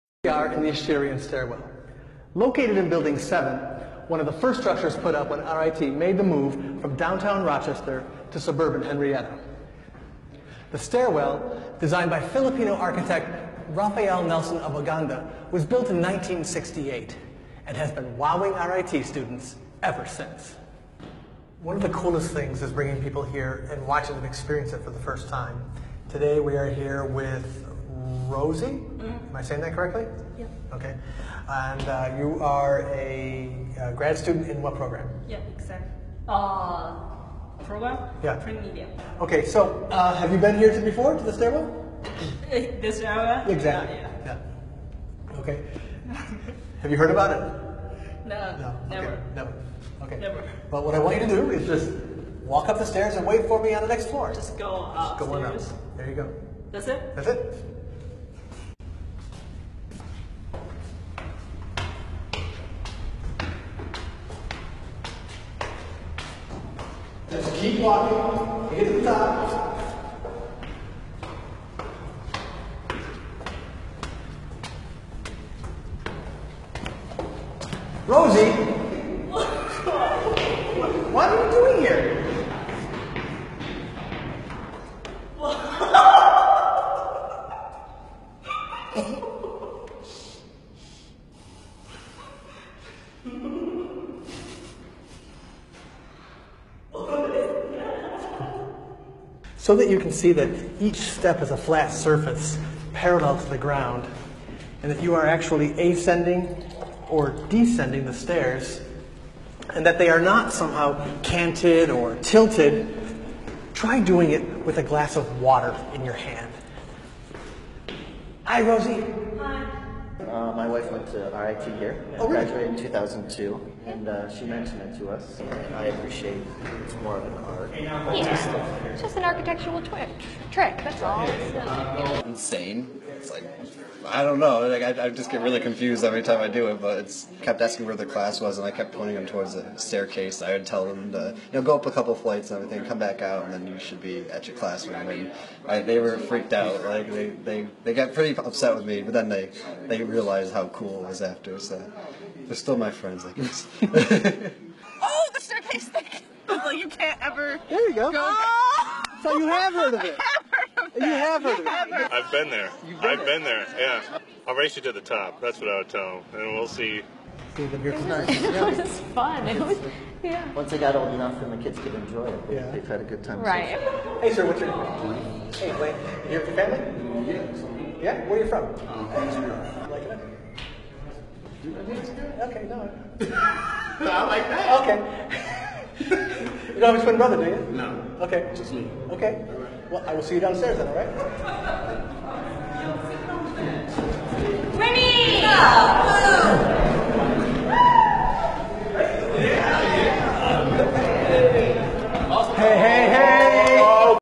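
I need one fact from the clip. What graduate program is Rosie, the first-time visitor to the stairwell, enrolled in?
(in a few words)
Print media.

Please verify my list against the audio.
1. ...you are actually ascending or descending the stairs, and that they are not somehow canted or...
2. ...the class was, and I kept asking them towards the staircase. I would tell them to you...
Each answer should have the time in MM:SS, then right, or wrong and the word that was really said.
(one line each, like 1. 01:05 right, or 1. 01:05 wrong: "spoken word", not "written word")
1. 01:45 right
2. 02:17 wrong: "pointing", not "asking".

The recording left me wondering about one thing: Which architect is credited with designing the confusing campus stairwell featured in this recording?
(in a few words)
Rafael Nelson Aboganda.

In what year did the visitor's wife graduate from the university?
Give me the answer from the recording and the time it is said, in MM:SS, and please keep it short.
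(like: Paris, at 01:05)
2002, at 02:02.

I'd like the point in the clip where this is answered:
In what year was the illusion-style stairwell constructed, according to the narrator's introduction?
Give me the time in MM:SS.
00:15.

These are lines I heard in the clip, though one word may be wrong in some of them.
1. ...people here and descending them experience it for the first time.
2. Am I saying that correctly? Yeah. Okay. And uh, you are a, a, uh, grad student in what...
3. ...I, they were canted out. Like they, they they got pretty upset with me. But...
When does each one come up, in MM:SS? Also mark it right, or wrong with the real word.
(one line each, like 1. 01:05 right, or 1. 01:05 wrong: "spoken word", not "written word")
1. 00:23 wrong: "watching", not "descending"
2. 00:29 right
3. 02:25 wrong: "freaked", not "canted".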